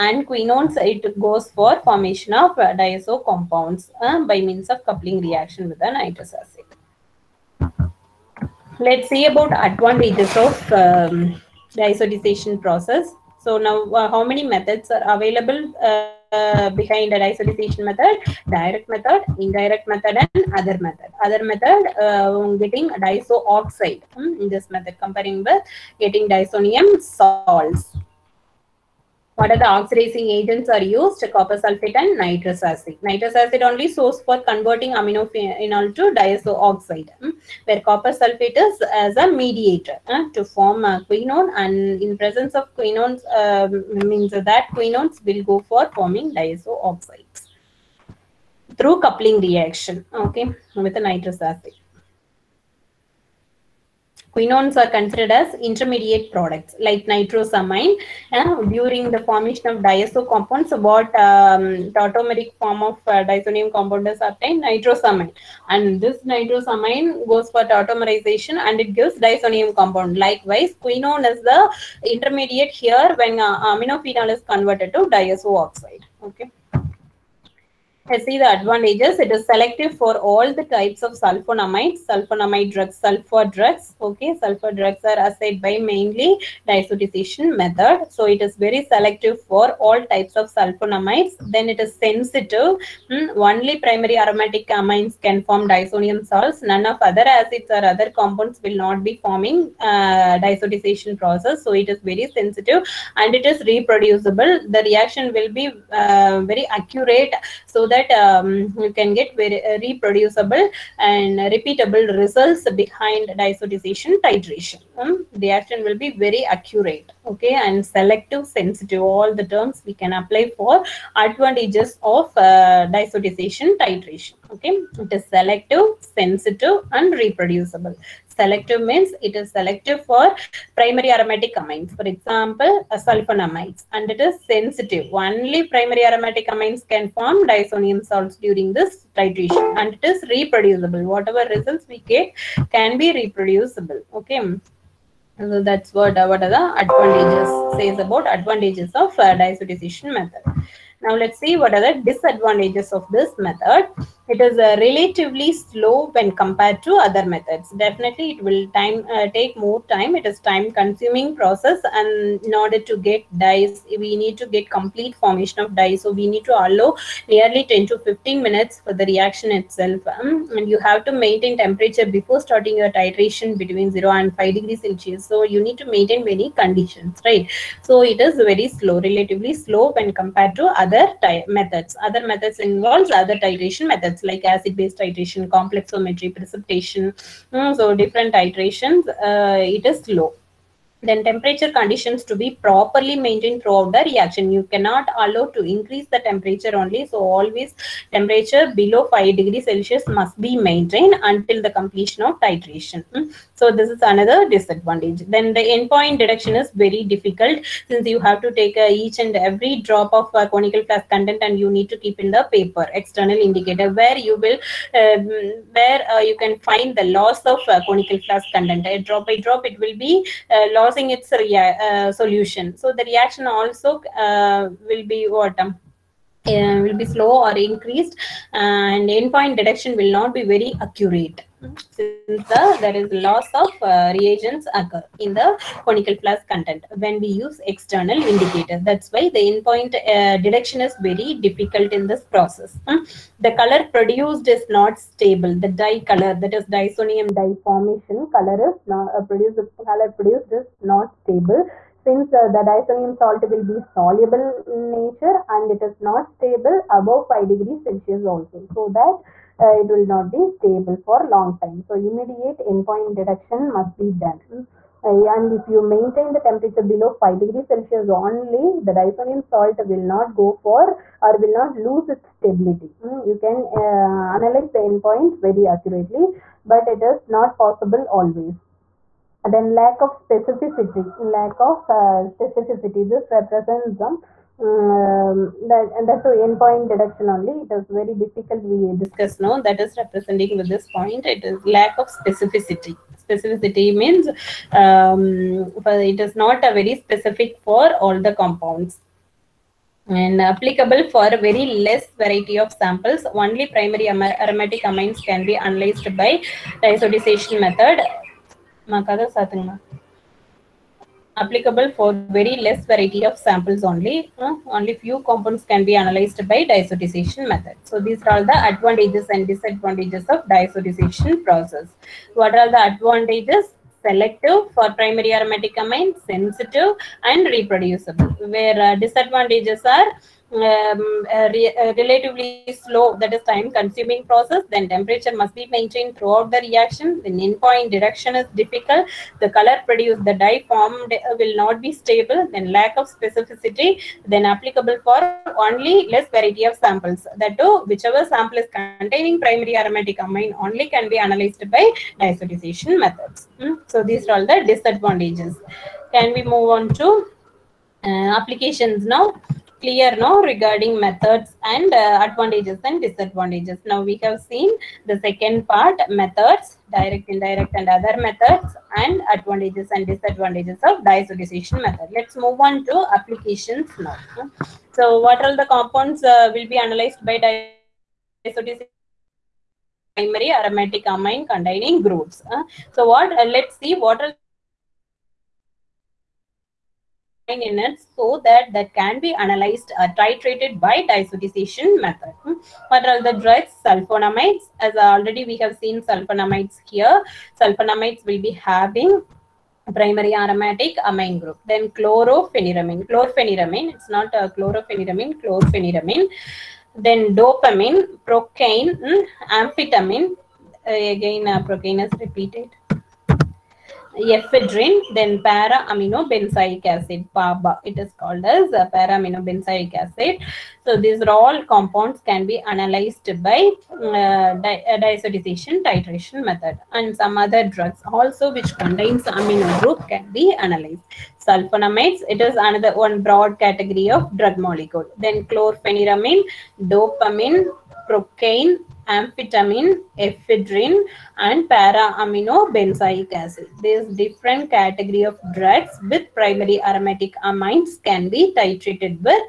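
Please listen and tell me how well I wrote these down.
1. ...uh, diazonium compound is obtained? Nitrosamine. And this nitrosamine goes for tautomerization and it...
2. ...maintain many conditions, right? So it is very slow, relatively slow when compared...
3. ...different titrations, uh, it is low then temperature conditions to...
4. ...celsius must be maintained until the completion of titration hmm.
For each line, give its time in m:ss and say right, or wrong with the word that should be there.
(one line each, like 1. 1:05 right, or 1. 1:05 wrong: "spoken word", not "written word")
1. 1:03 right
2. 2:55 right
3. 3:07 right
4. 3:19 right.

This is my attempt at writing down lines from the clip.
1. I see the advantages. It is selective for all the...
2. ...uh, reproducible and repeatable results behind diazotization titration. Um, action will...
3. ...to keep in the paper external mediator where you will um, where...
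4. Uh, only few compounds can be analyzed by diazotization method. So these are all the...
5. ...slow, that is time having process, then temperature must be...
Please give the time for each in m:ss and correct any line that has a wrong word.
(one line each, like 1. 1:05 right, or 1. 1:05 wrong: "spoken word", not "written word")
1. 1:18 right
2. 1:49 right
3. 3:31 wrong: "indicator", not "mediator"
4. 5:14 right
5. 5:32 wrong: "consuming", not "having".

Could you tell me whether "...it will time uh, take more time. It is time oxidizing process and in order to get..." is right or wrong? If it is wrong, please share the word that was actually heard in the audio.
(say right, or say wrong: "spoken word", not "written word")
wrong: "consuming", not "oxidizing".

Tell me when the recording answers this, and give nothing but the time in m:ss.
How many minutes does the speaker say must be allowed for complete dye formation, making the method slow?
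2:47.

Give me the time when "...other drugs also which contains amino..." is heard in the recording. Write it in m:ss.
7:07.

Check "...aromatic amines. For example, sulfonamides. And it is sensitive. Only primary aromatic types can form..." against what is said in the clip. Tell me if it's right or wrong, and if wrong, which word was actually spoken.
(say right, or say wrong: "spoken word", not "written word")
wrong: "amines", not "types".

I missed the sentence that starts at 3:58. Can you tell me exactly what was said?
That's why the endpoint uh, detection is very difficult in this process.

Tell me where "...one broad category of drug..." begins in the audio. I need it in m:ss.
7:12.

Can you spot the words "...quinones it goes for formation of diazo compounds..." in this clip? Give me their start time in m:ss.
0:00.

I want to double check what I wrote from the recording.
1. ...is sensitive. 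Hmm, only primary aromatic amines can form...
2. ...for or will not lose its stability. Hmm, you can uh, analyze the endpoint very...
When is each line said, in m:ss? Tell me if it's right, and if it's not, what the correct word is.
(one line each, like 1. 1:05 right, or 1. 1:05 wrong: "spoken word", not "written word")
1. 1:31 right
2. 4:30 right.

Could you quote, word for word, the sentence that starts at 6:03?
Now we have seen the second part methods, direct, indirect and other methods and advantages and disadvantages of diazotization method.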